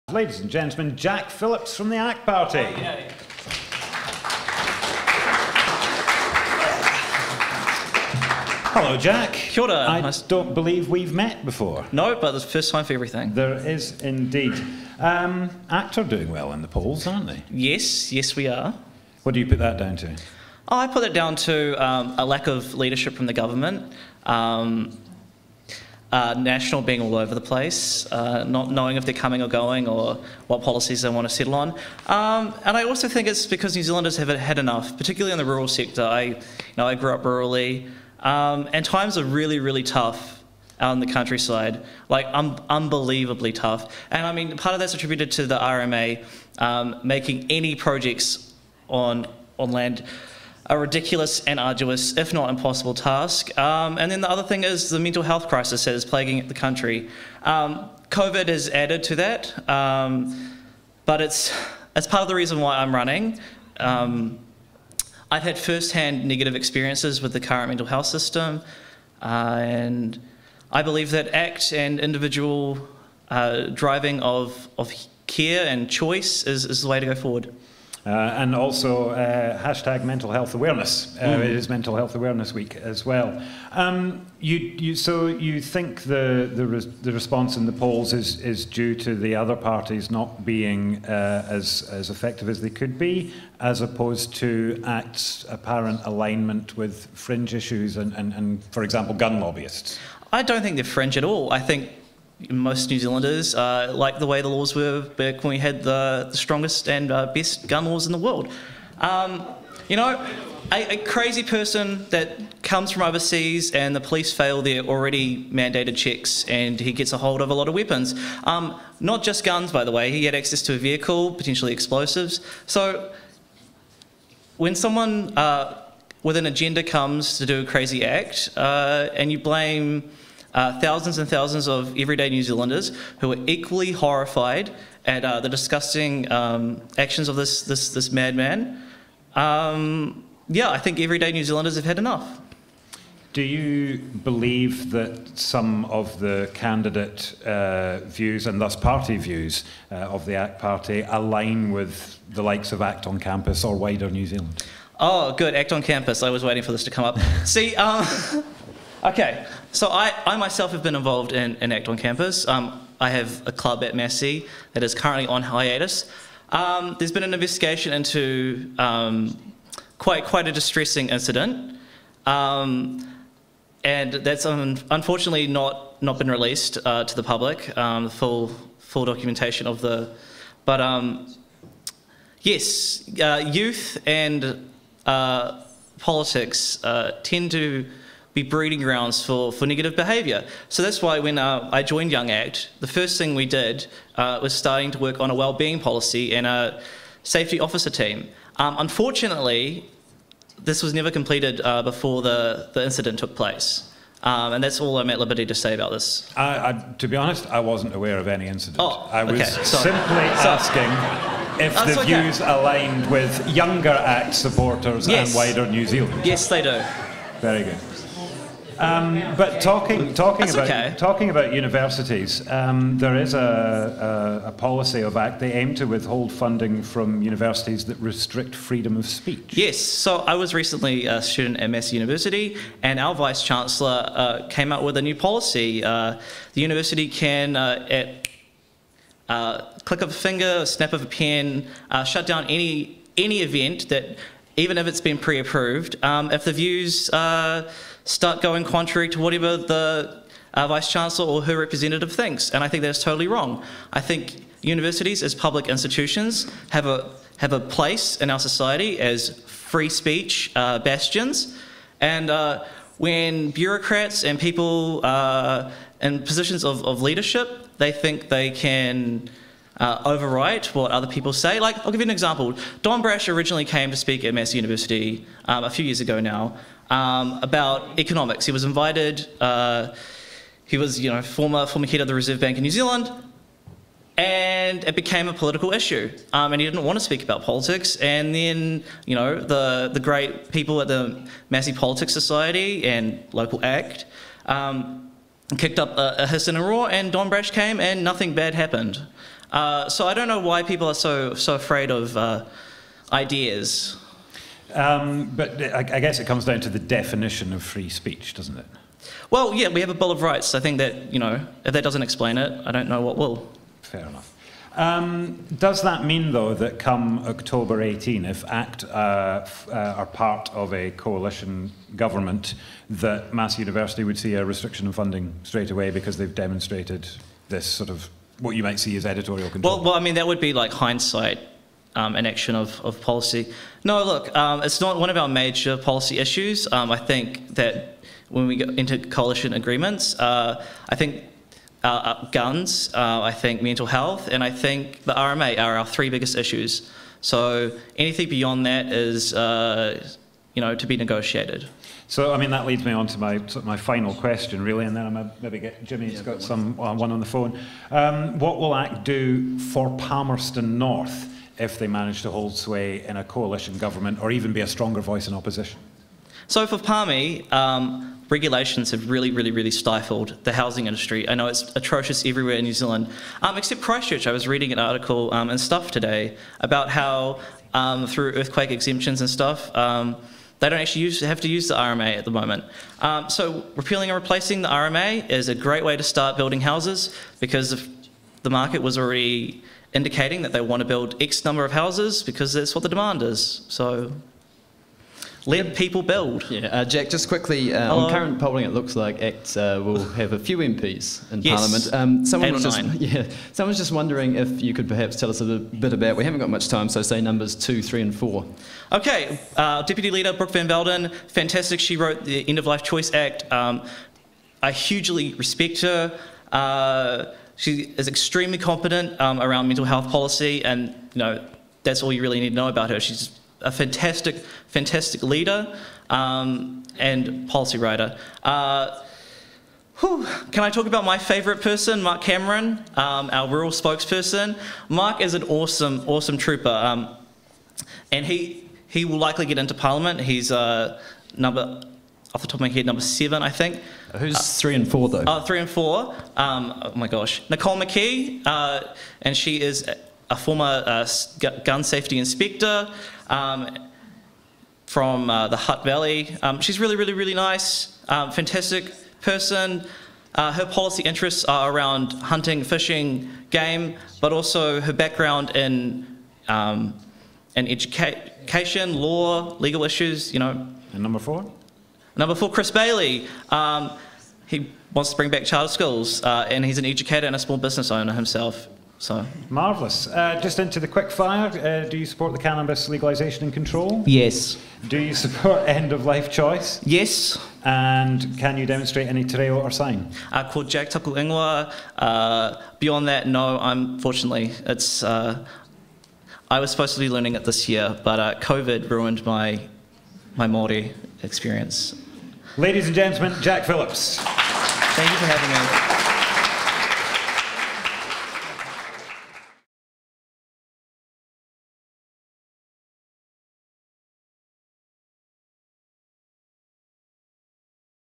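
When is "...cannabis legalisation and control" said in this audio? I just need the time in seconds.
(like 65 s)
482 s.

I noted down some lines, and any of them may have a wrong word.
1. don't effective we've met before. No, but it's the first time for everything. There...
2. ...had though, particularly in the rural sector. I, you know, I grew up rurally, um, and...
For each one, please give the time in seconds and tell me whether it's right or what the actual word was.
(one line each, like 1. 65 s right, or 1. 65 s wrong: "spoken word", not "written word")
1. 10 s wrong: "believe", not "effective"
2. 34 s wrong: "enough", not "though".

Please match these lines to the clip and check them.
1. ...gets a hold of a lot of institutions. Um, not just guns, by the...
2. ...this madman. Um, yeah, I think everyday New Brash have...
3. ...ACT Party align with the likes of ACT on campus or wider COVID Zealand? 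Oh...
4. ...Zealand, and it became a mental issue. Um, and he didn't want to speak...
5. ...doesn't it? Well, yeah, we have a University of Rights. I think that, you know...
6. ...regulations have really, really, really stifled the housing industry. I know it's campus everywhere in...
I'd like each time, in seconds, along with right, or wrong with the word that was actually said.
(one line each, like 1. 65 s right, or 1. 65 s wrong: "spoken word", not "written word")
1. 116 s wrong: "weapons", not "institutions"
2. 137 s wrong: "Zealanders", not "Brash"
3. 150 s wrong: "New", not "COVID"
4. 282 s wrong: "political", not "mental"
5. 308 s wrong: "Bill", not "University"
6. 368 s wrong: "atrocious", not "campus".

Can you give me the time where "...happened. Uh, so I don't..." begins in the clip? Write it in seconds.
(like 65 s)
298 s.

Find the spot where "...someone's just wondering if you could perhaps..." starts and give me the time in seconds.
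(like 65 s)
403 s.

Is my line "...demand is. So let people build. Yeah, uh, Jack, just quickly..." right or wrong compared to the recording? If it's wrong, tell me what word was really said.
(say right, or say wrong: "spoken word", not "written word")
right.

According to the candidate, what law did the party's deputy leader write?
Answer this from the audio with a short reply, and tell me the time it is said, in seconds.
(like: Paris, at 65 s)
End of Life Choice Act, at 412 s.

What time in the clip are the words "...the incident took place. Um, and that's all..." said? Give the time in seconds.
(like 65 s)
202 s.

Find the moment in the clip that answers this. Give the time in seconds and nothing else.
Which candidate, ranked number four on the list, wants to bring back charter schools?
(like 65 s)
472 s.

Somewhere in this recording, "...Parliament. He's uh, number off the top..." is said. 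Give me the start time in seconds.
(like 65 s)
439 s.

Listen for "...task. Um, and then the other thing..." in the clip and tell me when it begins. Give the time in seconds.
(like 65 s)
52 s.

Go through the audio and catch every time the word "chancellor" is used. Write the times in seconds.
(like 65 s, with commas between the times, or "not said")
233 s, 250 s.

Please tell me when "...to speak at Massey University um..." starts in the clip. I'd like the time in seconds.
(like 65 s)
273 s.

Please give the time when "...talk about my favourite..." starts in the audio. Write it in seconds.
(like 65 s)
430 s.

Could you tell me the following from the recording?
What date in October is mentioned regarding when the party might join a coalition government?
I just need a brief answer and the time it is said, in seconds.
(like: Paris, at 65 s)
October 18, at 317 s.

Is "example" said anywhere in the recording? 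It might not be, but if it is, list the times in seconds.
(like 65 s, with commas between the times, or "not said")
98 s, 272 s.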